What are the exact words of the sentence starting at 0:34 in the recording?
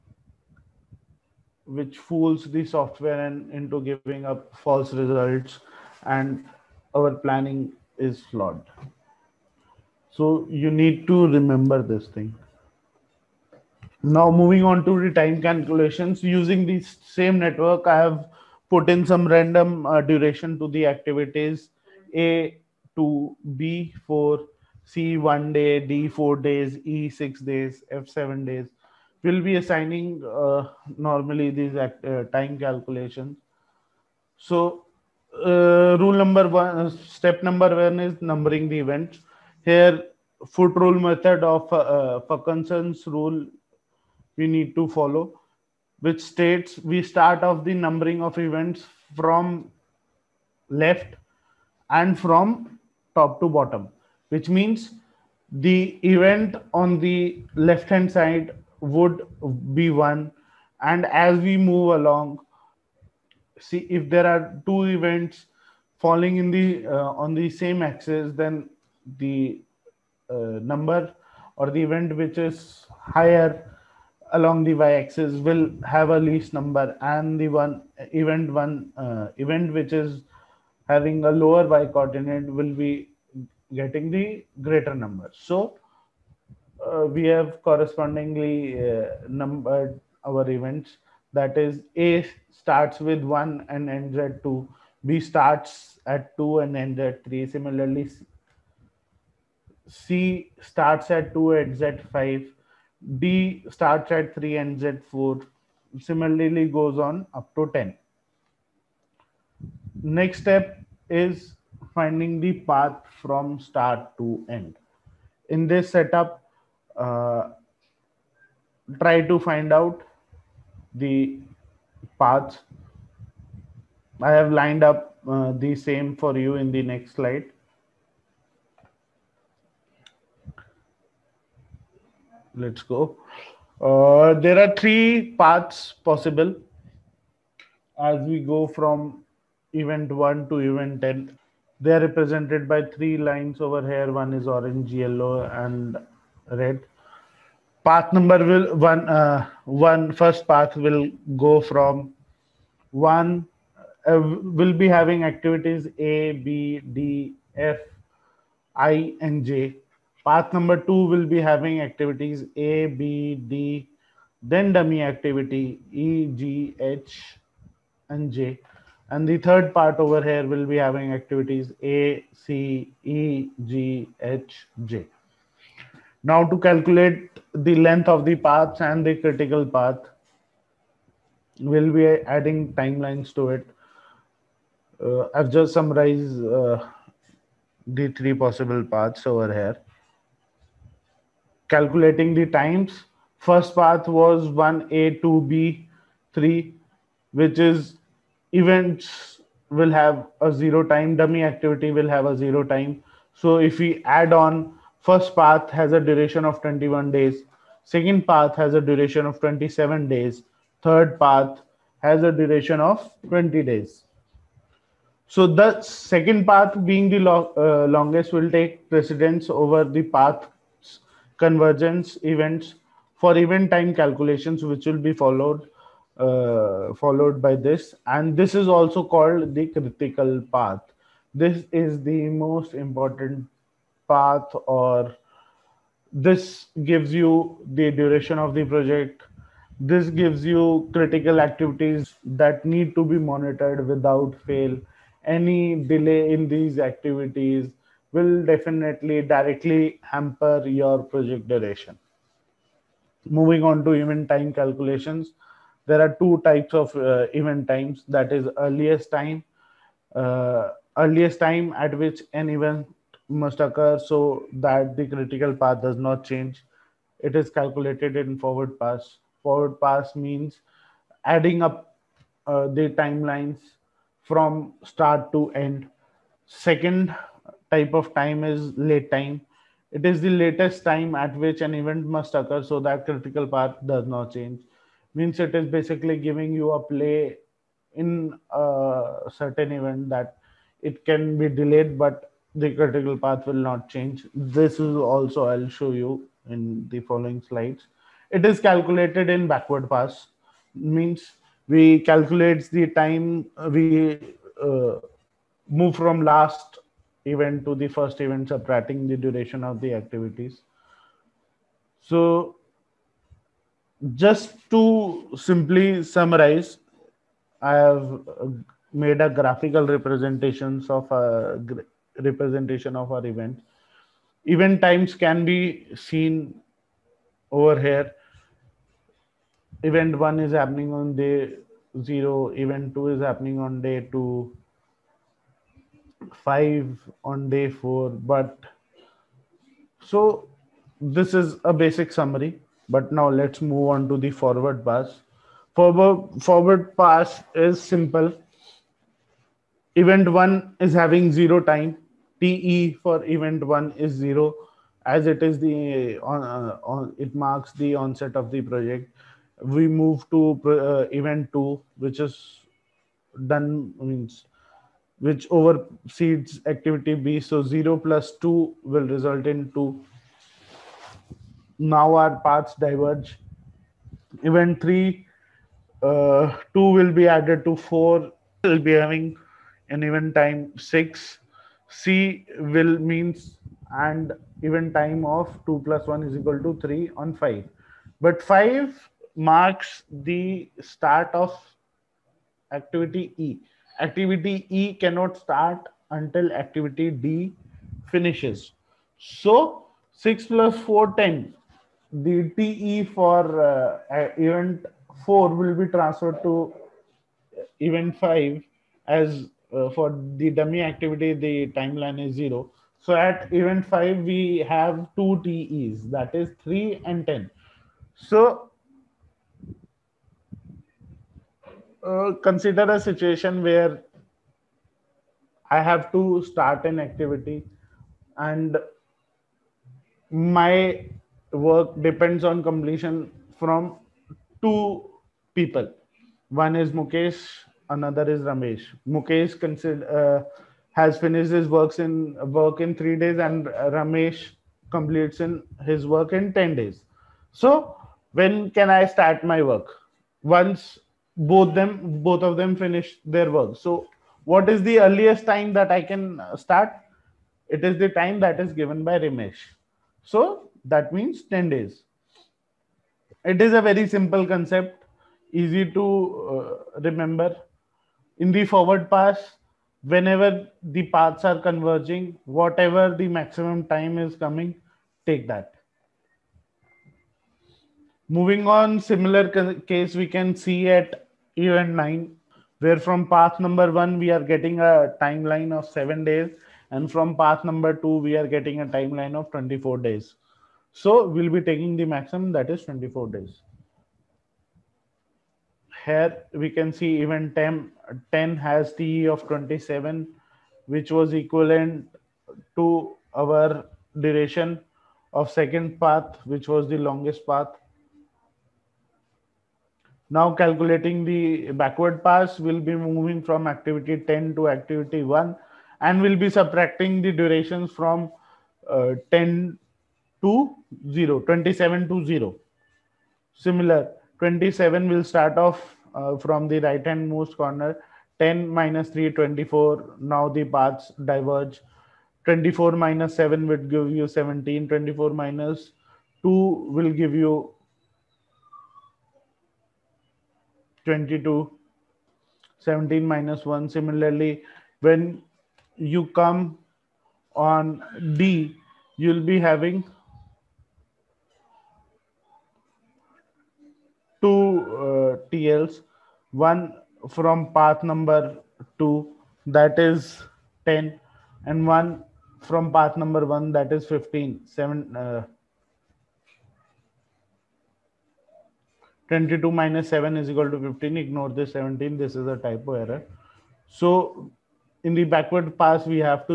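So uh, rule number one, uh, step number one is numbering the events.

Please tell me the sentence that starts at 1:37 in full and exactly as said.
Similarly, C starts at 2, ends at 5.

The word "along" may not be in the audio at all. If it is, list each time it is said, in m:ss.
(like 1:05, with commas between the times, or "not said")
1:01, 1:14.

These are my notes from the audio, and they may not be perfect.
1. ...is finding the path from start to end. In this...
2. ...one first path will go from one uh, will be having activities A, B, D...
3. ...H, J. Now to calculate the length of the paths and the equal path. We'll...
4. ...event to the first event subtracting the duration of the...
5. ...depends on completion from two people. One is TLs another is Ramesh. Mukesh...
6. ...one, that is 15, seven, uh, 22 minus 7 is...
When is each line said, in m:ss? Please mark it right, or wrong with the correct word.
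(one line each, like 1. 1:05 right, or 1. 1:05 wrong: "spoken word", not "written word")
1. 1:51 right
2. 2:29 right
3. 2:54 wrong: "critical", not "equal"
4. 5:07 right
5. 7:12 wrong: "Mukesh", not "TLs"
6. 9:23 right.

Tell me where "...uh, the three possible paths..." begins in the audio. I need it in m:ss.
3:06.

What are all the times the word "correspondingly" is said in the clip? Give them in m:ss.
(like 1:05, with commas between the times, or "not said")
1:27.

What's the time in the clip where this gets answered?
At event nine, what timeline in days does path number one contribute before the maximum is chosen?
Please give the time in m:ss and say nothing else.
8:06.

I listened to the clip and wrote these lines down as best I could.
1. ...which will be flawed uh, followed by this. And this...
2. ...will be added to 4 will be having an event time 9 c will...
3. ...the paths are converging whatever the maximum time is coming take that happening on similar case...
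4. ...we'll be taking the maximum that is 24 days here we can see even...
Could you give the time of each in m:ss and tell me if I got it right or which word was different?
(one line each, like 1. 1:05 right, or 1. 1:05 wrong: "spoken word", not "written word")
1. 3:44 wrong: "followed", not "flawed"
2. 6:16 wrong: "6", not "9"
3. 7:50 wrong: "moving", not "happening"
4. 8:11 right.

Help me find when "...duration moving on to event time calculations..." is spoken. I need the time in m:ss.
4:11.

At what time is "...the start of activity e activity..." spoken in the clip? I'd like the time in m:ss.
6:30.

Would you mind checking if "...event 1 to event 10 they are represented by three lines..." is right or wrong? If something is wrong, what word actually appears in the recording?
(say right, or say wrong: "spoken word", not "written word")
right.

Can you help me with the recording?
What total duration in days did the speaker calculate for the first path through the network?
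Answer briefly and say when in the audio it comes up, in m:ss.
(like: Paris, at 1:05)
21 days, at 3:26.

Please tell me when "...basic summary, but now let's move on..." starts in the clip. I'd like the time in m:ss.
5:41.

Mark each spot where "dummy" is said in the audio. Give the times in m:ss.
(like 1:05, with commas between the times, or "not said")
2:44, 3:21, 6:50.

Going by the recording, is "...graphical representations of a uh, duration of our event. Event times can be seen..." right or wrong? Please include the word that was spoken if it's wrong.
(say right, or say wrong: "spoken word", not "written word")
wrong: "representation", not "duration".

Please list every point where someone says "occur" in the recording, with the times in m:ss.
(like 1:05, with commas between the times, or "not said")
4:23, 4:42.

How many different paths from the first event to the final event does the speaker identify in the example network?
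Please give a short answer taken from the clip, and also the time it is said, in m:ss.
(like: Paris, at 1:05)
3, at 2:14.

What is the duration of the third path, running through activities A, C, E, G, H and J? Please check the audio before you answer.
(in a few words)
20 days.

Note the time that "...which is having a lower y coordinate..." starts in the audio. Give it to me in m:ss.
1:19.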